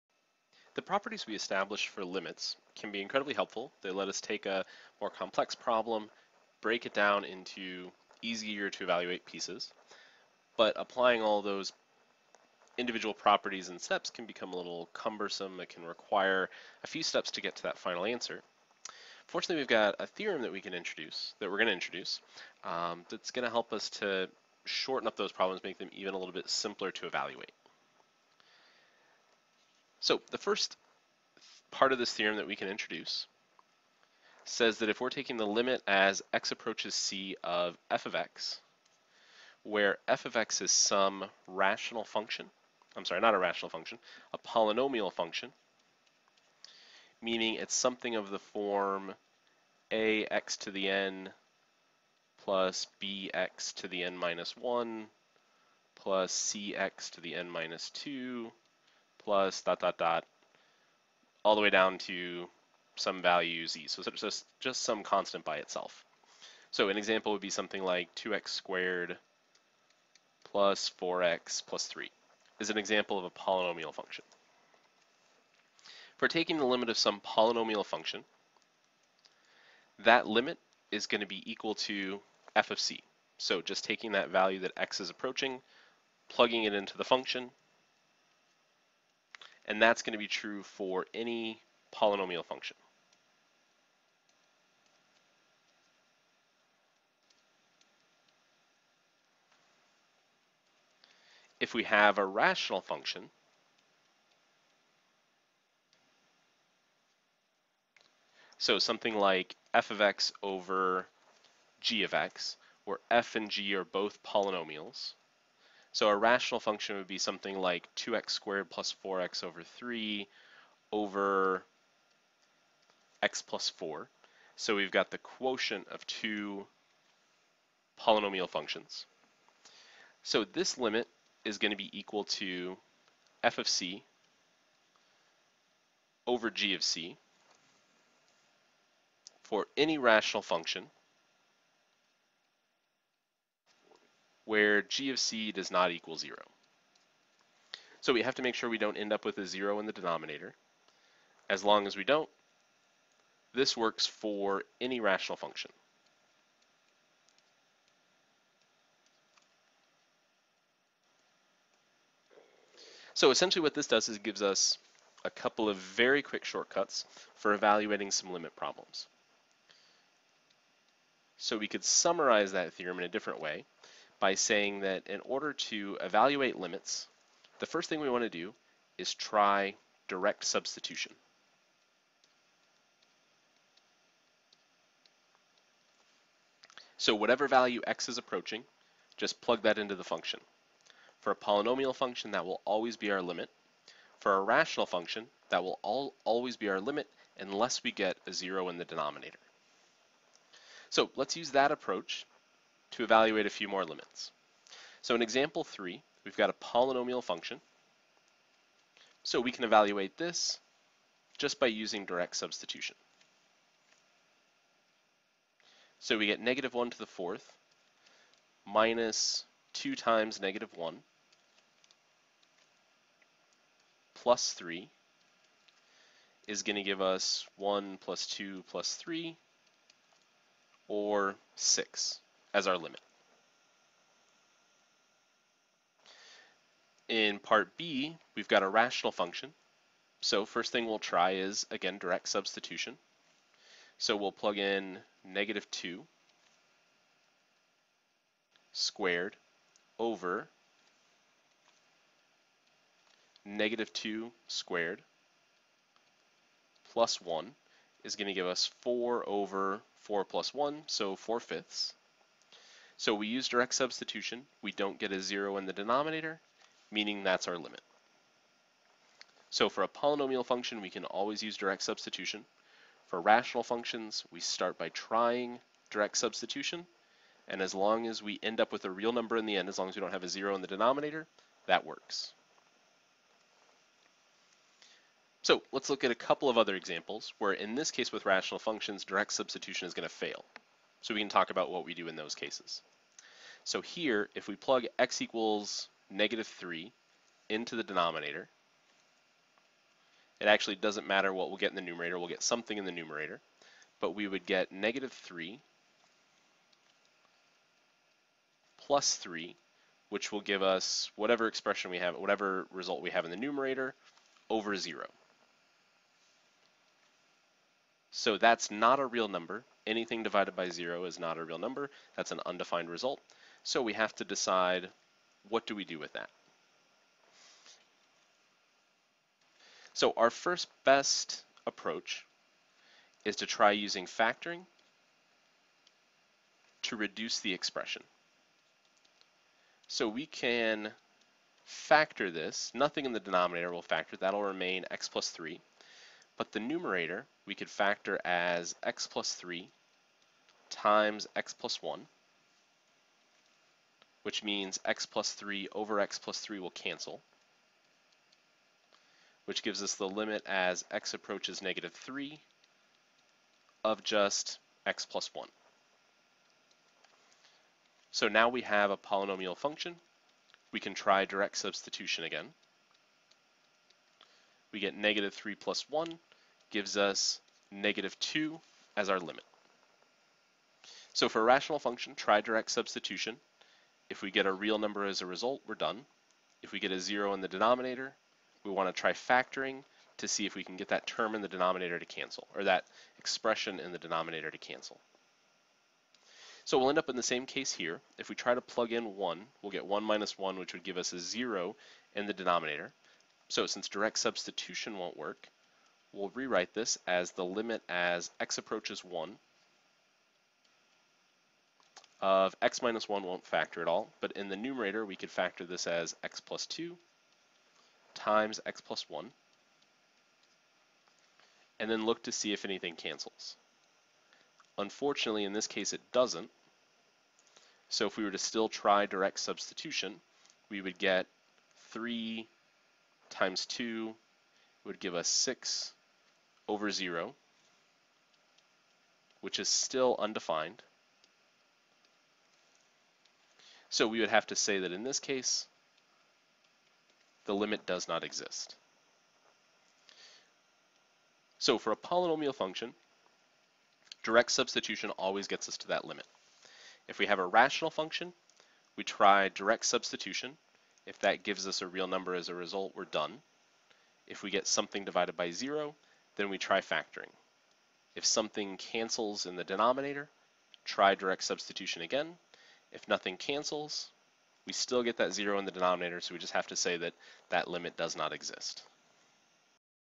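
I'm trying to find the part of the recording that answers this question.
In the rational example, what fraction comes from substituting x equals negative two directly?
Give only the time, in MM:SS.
04:21.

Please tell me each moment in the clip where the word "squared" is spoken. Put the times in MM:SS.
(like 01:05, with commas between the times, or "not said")
01:08, 01:58, 04:08, 04:14.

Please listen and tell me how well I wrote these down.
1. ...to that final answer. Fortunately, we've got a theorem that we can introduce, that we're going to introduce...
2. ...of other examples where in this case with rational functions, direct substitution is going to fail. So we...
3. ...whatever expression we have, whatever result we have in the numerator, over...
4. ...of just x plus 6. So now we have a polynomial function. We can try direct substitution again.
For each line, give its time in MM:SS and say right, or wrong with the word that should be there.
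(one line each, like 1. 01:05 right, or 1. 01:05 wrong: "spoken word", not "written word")
1. 00:17 right
2. 04:46 right
3. 05:11 right
4. 06:03 wrong: "1", not "6".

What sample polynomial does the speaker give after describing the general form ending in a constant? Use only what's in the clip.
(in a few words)
2x^2 + 4x + 3.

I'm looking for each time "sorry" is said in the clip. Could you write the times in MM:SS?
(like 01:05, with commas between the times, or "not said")
00:43.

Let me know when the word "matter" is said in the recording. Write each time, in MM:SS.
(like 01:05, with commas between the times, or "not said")
05:01.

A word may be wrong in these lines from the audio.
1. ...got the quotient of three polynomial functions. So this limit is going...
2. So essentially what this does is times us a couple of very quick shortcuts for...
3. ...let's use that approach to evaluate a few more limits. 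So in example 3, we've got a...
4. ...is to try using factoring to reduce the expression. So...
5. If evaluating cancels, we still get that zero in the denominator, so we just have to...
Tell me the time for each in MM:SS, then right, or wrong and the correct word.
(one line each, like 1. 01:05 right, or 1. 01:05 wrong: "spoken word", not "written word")
1. 02:04 wrong: "two", not "three"
2. 02:43 wrong: "gives", not "times"
3. 03:21 right
4. 05:33 right
5. 07:52 wrong: "nothing", not "evaluating".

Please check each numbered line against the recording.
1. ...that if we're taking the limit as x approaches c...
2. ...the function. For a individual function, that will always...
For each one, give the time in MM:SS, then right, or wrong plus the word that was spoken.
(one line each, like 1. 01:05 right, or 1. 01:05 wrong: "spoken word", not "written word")
1. 00:34 right
2. 03:09 wrong: "polynomial", not "individual".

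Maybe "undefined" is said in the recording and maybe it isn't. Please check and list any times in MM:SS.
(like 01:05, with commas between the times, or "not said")
05:22, 07:20.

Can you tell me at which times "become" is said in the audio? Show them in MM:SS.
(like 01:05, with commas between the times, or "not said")
00:14.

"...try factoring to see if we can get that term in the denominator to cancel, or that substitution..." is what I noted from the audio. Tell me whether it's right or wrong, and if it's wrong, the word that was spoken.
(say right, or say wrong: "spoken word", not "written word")
wrong: "expression", not "substitution".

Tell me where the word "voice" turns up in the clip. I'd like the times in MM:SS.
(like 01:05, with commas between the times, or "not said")
not said.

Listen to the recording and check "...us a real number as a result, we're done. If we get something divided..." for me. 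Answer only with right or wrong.
right.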